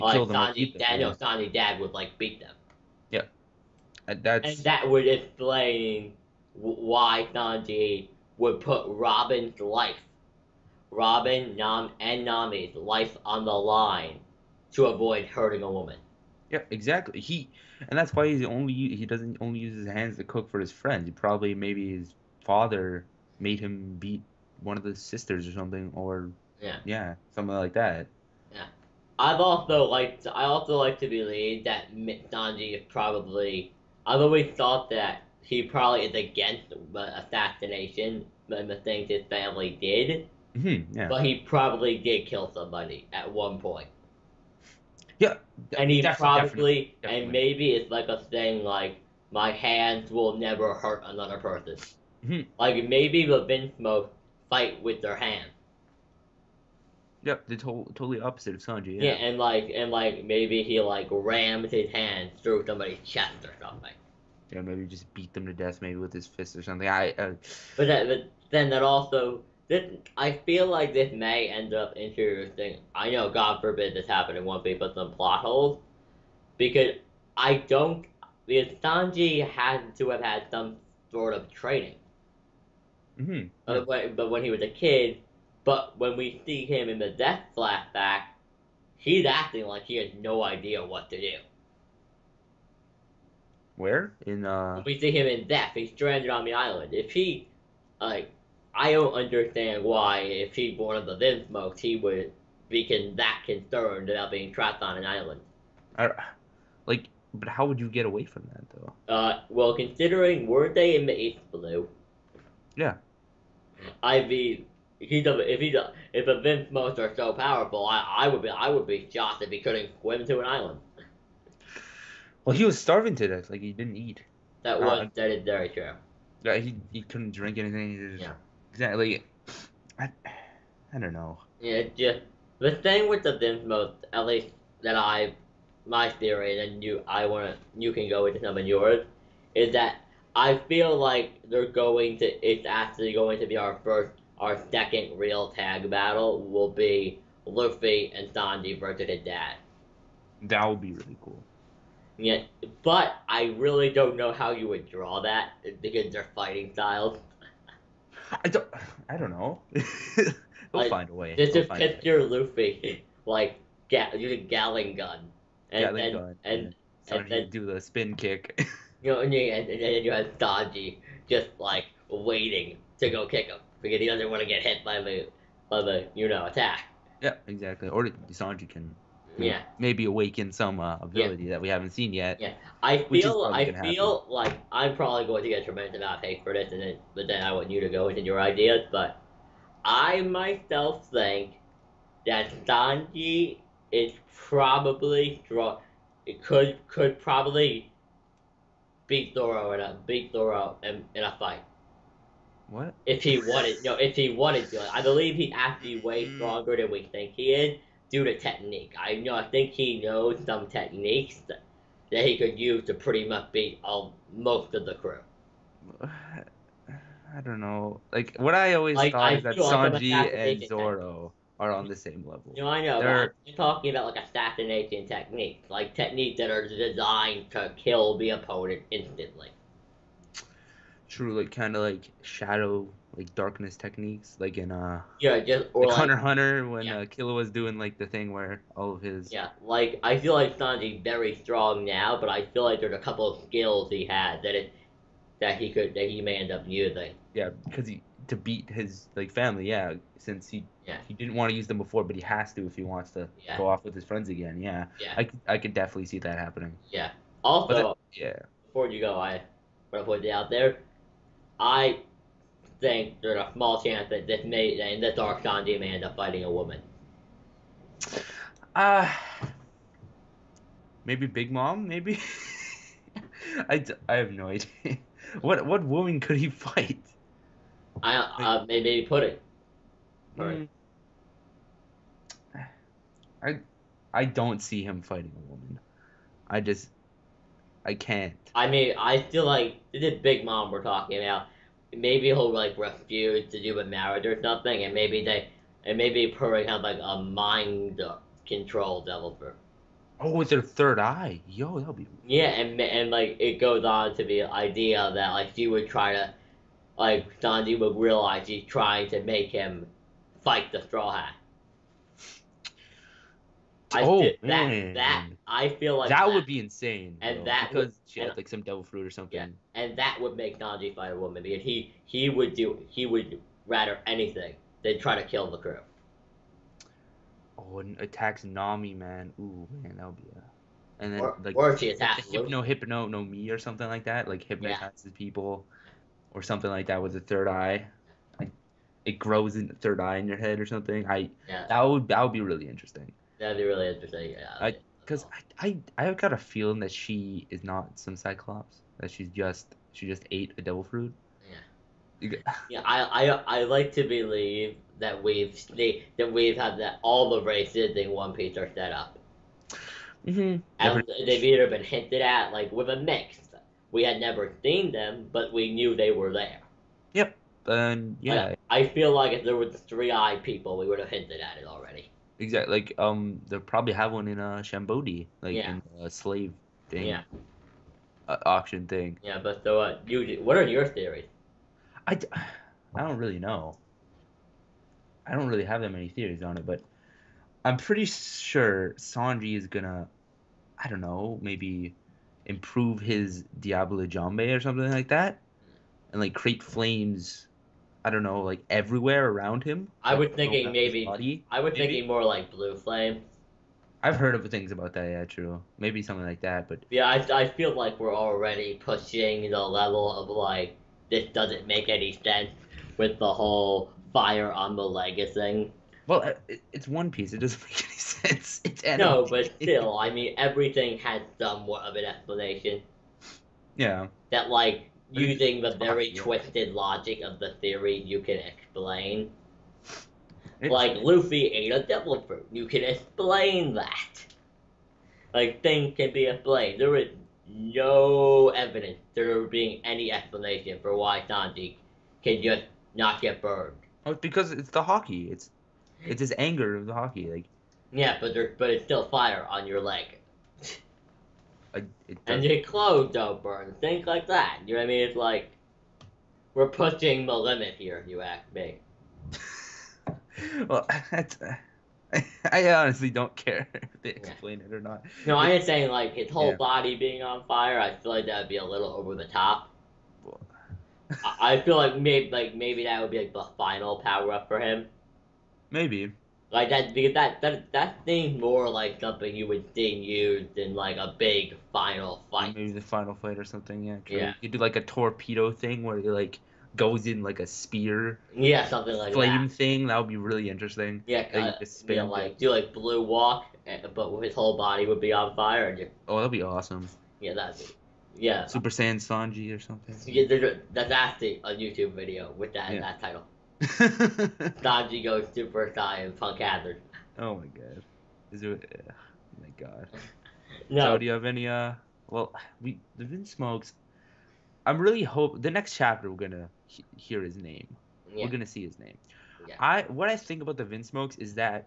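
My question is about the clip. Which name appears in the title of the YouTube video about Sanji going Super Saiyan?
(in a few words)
Punk Hazard.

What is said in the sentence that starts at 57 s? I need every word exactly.
Yep, the to- totally opposite of Sanji.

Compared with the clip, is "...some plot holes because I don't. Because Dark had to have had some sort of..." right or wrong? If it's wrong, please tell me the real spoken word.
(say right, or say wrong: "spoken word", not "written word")
wrong: "Sanji", not "Dark".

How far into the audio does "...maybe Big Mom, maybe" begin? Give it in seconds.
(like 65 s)
271 s.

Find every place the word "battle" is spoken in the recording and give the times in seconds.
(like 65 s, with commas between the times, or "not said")
145 s.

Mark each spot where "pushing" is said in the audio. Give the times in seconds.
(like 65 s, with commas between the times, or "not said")
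408 s, 456 s.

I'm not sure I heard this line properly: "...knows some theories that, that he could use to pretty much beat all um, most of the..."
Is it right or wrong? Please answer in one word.
wrong.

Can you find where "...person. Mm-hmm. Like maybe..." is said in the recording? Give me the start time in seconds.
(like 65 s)
51 s.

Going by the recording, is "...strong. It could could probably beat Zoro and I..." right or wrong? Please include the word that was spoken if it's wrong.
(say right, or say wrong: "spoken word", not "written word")
right.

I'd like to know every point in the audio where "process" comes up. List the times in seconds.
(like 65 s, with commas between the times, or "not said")
not said.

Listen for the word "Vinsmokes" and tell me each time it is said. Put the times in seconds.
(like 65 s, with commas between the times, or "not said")
101 s, 116 s, 133 s, 513 s, 520 s.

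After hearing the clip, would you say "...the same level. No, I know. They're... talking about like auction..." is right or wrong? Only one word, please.
wrong.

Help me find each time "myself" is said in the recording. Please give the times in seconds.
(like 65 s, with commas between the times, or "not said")
190 s.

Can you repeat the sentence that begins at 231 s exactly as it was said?
True, like, kind of like shadow, like darkness techniques, like in uh.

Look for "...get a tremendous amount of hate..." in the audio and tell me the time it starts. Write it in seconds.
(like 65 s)
185 s.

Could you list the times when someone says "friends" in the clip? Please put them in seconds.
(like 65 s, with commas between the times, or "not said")
20 s, 254 s.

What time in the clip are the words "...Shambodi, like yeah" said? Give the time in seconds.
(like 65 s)
374 s.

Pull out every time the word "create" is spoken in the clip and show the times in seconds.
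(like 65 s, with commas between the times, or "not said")
396 s.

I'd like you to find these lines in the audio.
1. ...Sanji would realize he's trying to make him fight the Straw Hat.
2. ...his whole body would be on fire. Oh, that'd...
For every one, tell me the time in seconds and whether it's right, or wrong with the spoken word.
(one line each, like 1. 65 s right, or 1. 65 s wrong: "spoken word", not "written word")
1. 307 s right
2. 494 s right.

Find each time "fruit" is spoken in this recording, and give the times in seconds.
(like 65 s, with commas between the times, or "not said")
318 s, 350 s, 432 s.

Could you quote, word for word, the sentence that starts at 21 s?
He probably maybe his father made him beat one of the sisters or something, or yeah, yeah, something like that.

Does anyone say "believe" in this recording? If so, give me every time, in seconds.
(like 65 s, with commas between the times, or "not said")
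31 s, 205 s, 354 s.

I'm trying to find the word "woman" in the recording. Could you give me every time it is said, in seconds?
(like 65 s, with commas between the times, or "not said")
15 s, 266 s, 275 s, 285 s, 321 s.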